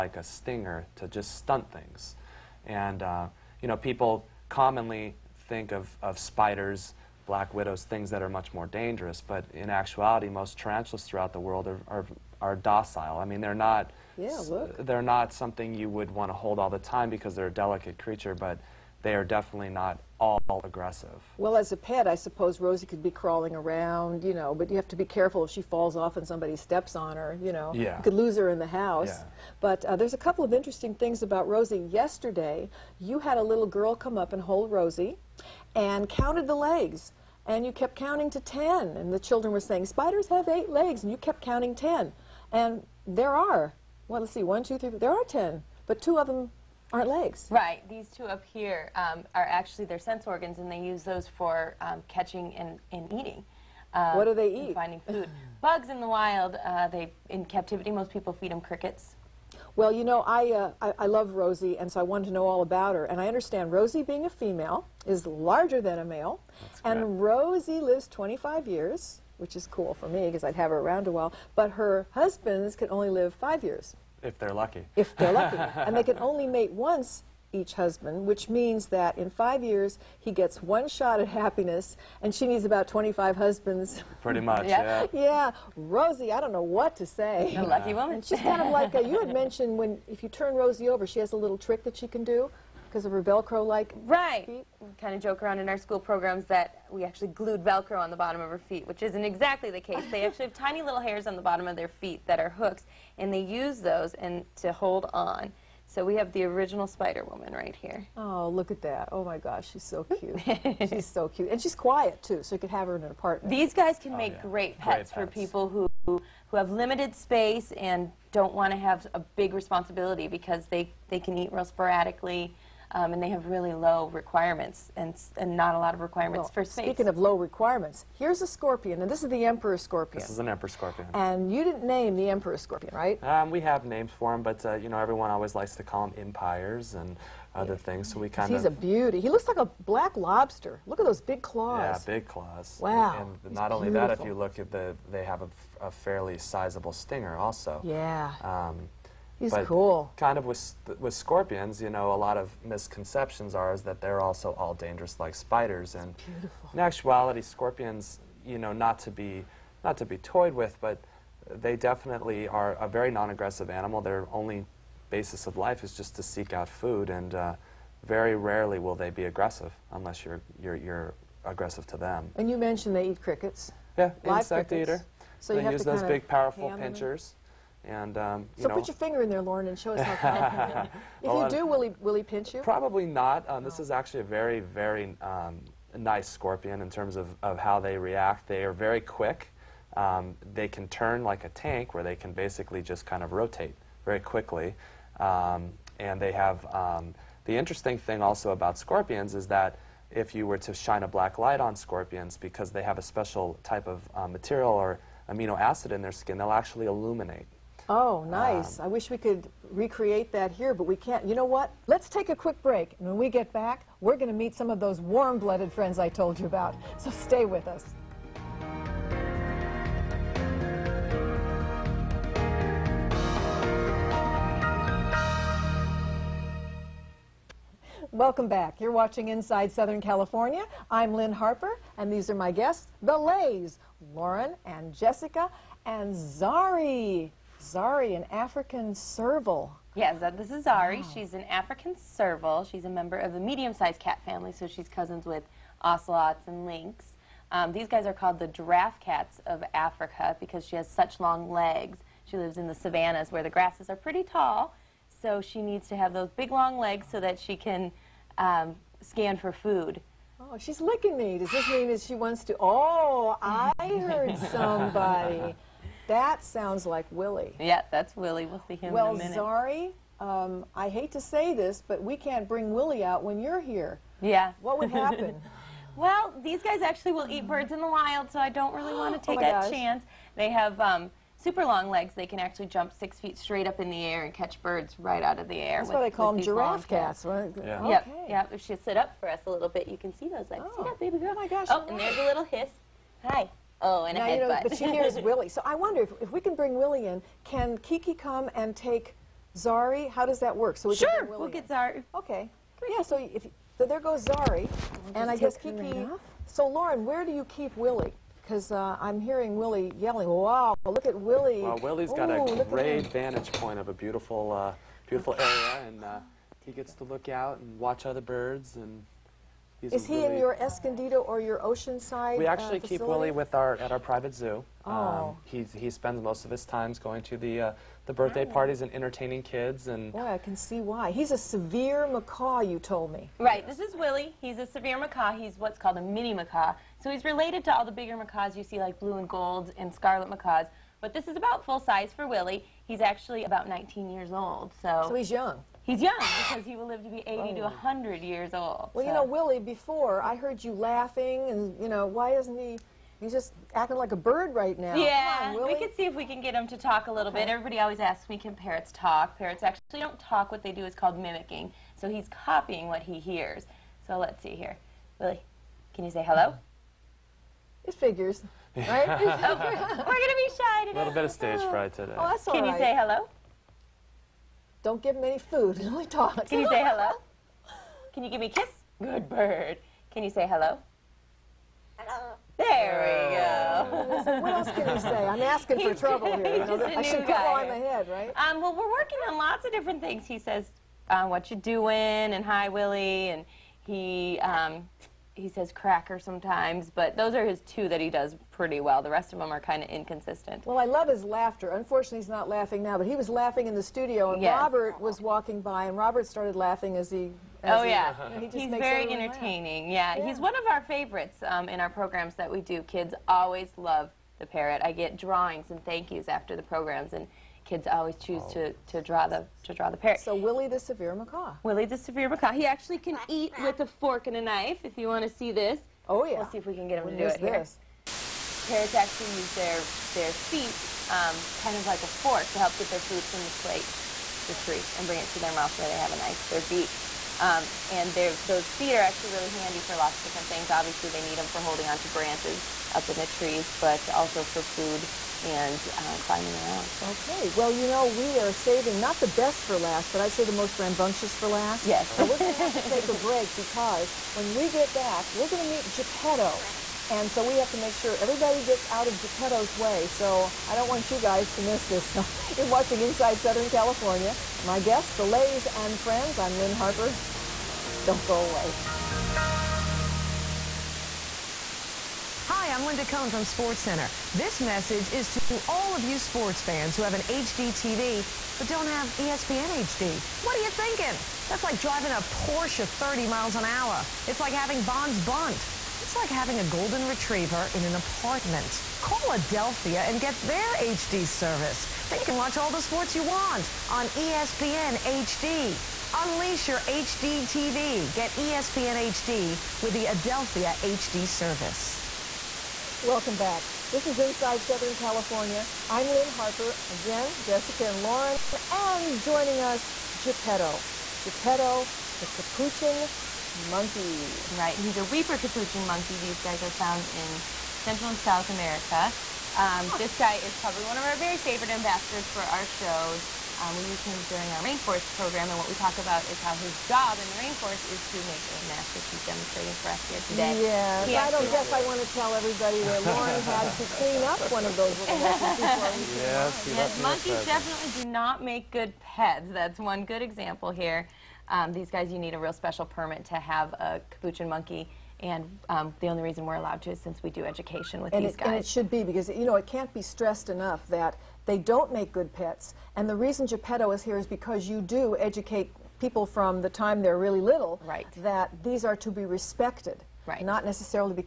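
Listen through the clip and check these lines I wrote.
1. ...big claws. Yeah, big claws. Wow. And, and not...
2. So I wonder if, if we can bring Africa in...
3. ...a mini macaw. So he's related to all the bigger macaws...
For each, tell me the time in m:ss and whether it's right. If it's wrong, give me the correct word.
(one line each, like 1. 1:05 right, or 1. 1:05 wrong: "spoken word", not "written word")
1. 2:21 right
2. 4:55 wrong: "Willie", not "Africa"
3. 5:35 right.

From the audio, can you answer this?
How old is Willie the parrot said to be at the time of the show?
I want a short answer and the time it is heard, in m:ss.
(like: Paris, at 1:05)
19, at 5:43.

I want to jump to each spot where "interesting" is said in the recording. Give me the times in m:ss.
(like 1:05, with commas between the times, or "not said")
0:30, 3:17.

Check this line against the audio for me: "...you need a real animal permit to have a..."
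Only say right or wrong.
wrong.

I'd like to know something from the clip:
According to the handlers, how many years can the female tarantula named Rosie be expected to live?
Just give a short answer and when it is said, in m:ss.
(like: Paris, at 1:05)
25, at 1:07.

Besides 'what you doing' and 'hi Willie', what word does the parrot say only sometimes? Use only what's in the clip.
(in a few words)
cracker.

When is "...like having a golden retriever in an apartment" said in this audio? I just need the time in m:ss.
8:06.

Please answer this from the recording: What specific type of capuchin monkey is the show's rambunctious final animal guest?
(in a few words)
weeper capuchin.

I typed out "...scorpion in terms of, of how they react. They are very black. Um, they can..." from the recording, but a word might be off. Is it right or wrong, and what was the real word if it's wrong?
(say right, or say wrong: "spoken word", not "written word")
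wrong: "quick", not "black".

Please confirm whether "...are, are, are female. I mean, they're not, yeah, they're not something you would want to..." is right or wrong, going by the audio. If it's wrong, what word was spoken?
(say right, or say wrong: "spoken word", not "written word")
wrong: "docile", not "female".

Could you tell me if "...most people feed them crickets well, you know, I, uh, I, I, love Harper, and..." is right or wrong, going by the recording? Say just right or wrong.
wrong.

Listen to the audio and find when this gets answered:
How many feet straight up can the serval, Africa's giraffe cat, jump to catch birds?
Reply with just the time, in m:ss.
4:42.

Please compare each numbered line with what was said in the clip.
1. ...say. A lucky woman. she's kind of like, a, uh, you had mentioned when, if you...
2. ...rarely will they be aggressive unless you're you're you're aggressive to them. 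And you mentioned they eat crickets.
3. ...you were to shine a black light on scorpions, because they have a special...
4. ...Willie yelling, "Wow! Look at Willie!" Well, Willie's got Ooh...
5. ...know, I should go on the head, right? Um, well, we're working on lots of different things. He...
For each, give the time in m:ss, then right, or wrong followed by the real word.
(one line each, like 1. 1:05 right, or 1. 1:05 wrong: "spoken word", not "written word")
1. 1:27 right
2. 2:48 right
3. 3:20 right
4. 5:09 right
5. 6:26 right.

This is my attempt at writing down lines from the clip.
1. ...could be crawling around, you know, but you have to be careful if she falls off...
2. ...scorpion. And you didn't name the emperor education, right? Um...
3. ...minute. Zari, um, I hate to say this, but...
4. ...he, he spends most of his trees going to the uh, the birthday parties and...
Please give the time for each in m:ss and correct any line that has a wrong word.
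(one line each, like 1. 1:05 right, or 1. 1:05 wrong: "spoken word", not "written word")
1. 0:22 right
2. 2:10 wrong: "scorpion", not "education"
3. 4:29 right
4. 5:25 wrong: "times", not "trees".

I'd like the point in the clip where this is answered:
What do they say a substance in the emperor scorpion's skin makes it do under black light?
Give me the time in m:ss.
3:26.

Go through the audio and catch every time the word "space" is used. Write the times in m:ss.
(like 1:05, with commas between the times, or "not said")
1:57, 2:06.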